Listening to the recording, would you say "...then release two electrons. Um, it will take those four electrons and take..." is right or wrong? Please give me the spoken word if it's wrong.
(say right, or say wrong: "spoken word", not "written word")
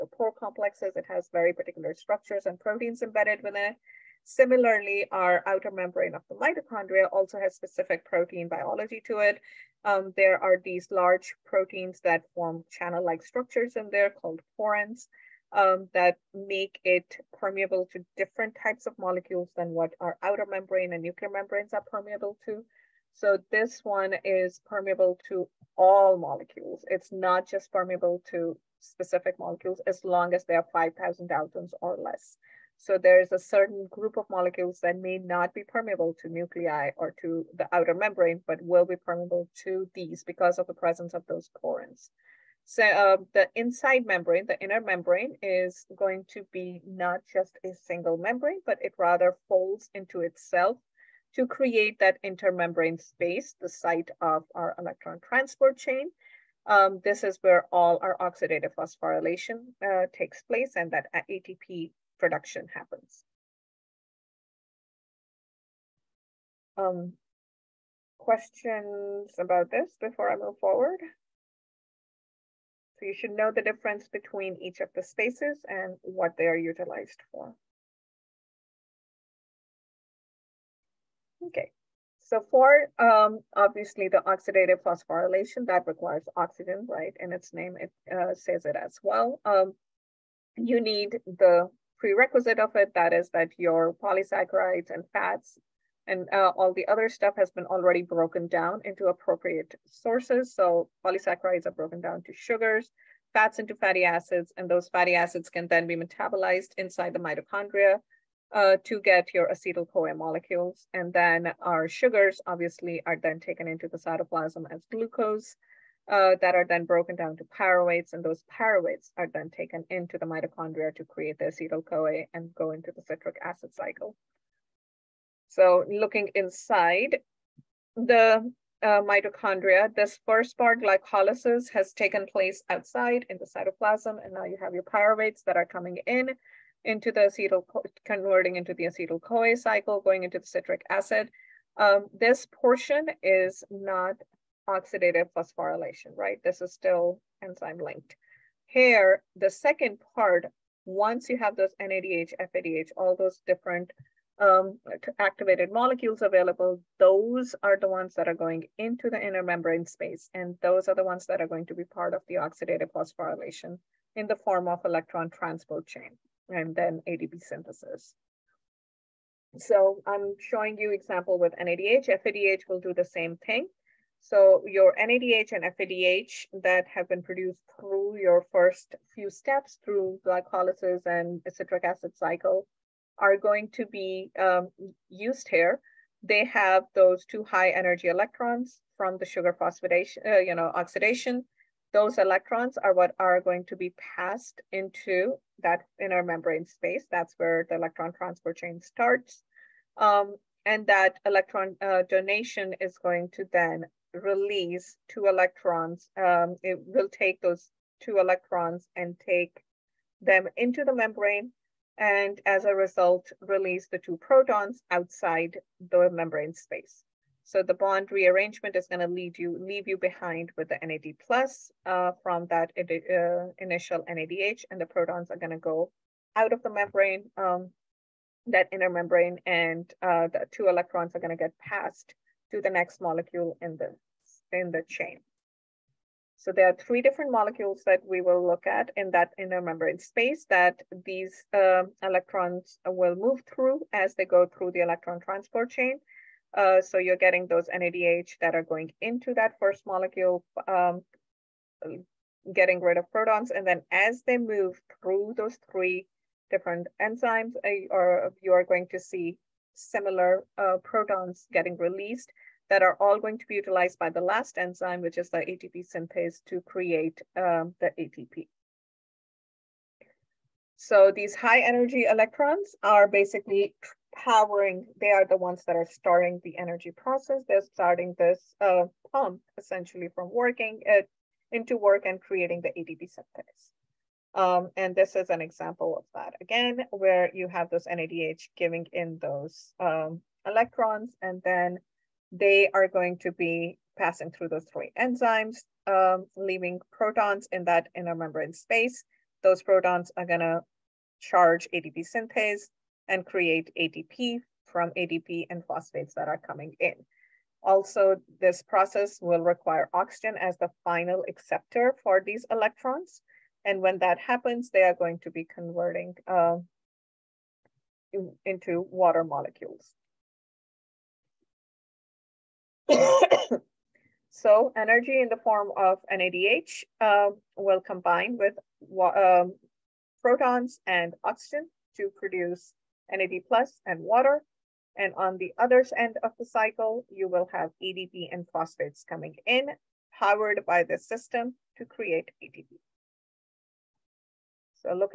wrong: "two", not "four".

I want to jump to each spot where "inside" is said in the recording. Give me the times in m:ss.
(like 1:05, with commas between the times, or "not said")
0:43, 1:46, 2:06.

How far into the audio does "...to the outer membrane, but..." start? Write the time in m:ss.
0:37.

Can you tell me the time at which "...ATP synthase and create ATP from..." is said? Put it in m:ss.
5:01.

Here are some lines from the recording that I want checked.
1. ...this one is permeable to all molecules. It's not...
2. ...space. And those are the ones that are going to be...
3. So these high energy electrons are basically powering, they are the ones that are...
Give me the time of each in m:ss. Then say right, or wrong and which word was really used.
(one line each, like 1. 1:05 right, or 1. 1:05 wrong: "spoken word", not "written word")
1. 0:23 right
2. 2:39 right
3. 4:30 right.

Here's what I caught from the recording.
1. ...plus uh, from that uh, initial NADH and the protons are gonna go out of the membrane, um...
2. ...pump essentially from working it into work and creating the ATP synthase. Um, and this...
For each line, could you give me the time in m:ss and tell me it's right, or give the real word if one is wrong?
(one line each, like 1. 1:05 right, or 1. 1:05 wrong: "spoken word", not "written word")
1. 3:41 right
2. 4:39 right.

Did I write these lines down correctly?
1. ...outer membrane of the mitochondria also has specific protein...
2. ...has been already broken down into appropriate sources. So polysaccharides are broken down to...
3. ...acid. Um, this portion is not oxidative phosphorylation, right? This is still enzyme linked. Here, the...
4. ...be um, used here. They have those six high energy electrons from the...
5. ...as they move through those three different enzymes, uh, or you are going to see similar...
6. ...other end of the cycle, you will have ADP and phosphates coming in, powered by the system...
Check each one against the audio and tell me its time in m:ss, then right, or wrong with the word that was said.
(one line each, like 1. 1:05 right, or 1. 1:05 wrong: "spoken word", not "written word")
1. 0:05 right
2. 1:37 right
3. 2:20 right
4. 3:03 wrong: "two", not "six"
5. 4:13 right
6. 5:35 right.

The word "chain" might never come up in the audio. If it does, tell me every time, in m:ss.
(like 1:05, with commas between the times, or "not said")
0:55, 2:45, 3:18, 3:54, 4:05.